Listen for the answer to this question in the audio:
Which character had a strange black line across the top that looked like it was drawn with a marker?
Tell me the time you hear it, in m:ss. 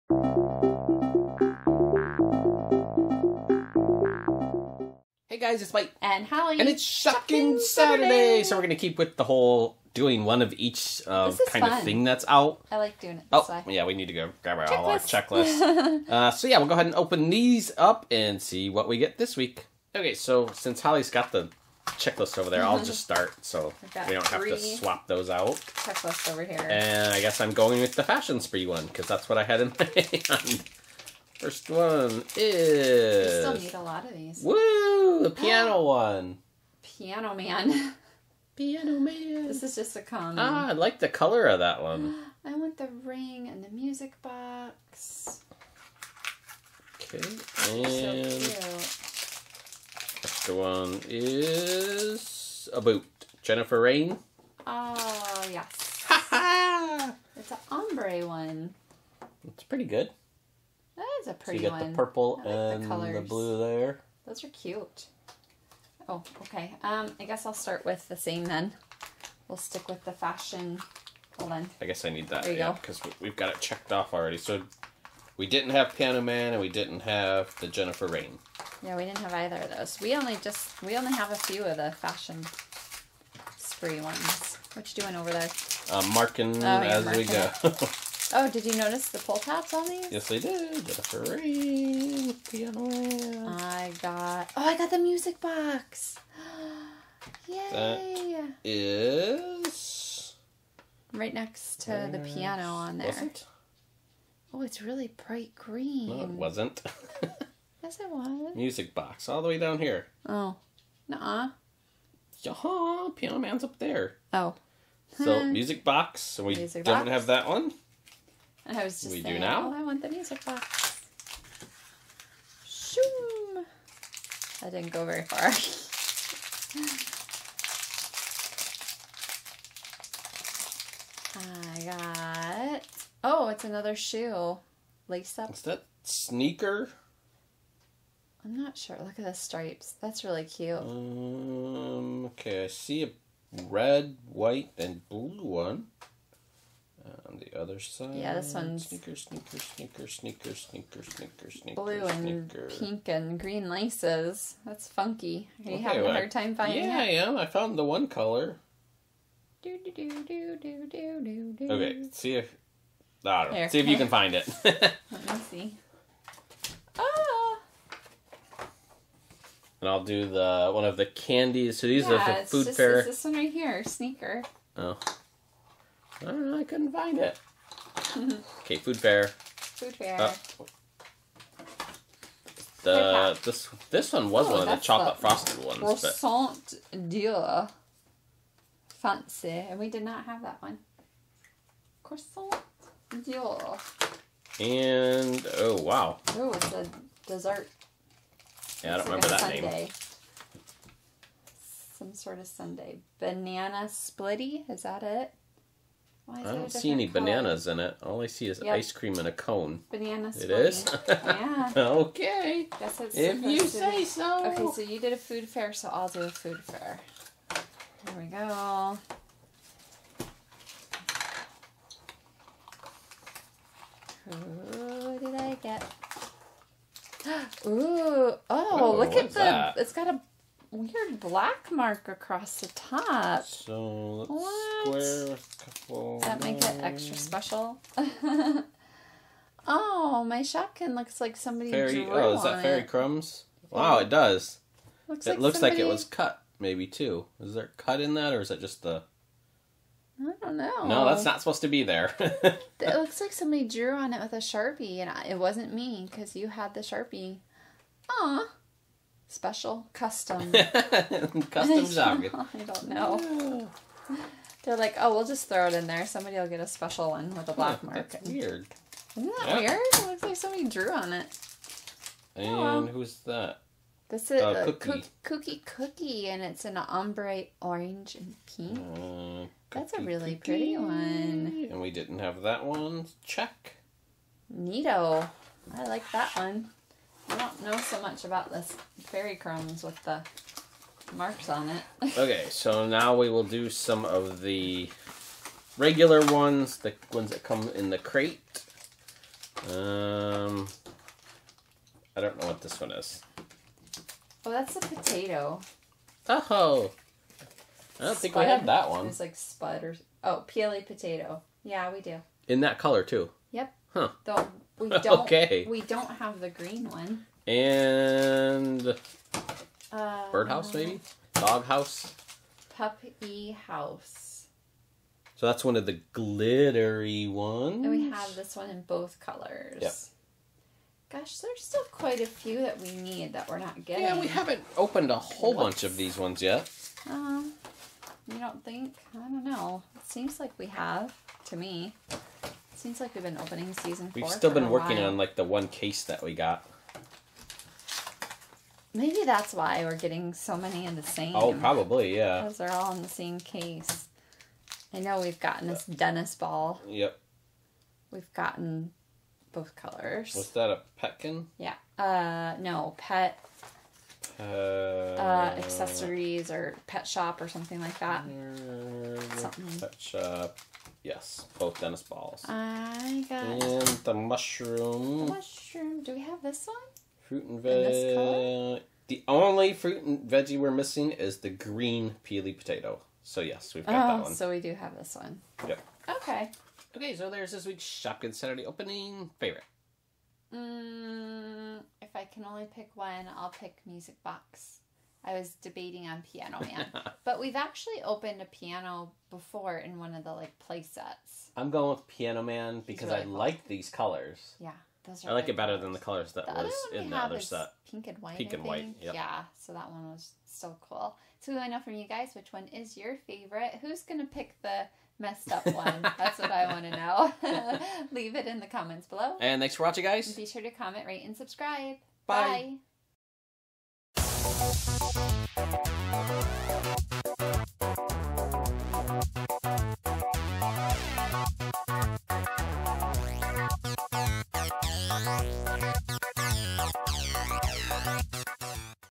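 4:49.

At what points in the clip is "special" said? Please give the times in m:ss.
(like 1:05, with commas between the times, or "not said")
3:57, 4:19, 4:26.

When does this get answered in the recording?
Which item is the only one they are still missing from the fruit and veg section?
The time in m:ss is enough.
6:21.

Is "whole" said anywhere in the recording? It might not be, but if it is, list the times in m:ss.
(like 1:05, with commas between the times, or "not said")
0:09, 5:35.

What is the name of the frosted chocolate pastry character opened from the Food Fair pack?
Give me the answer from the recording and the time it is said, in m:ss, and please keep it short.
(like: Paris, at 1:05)
Croissant d'or, at 3:12.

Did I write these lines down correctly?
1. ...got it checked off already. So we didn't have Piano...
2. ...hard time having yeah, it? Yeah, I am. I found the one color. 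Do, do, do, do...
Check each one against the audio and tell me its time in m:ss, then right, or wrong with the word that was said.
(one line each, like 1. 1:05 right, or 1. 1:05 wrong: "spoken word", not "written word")
1. 1:13 right
2. 2:36 wrong: "finding", not "having".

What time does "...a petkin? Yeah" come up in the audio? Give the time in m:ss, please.
6:00.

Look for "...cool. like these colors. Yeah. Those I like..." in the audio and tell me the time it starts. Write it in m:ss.
6:43.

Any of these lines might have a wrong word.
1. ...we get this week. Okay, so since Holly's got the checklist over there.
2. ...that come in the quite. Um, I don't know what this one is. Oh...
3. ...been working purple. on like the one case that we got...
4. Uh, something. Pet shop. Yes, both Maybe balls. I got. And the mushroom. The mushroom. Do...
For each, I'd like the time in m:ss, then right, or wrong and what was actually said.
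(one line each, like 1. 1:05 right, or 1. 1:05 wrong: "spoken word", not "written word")
1. 0:18 right
2. 4:57 wrong: "crate", not "quite"
3. 5:44 wrong: "while", not "purple"
4. 6:08 wrong: "Dennis", not "Maybe".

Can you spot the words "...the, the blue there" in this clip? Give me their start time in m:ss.
1:02.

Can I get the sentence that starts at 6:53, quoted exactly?
Who's gonna pick the messed up one?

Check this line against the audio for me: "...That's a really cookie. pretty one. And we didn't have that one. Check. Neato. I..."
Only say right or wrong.
right.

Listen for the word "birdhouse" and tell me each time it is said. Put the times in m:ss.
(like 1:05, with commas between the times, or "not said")
5:20.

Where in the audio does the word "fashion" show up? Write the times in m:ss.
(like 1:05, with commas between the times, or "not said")
0:28, 1:10, 1:21.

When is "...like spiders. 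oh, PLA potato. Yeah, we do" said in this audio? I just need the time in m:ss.
5:09.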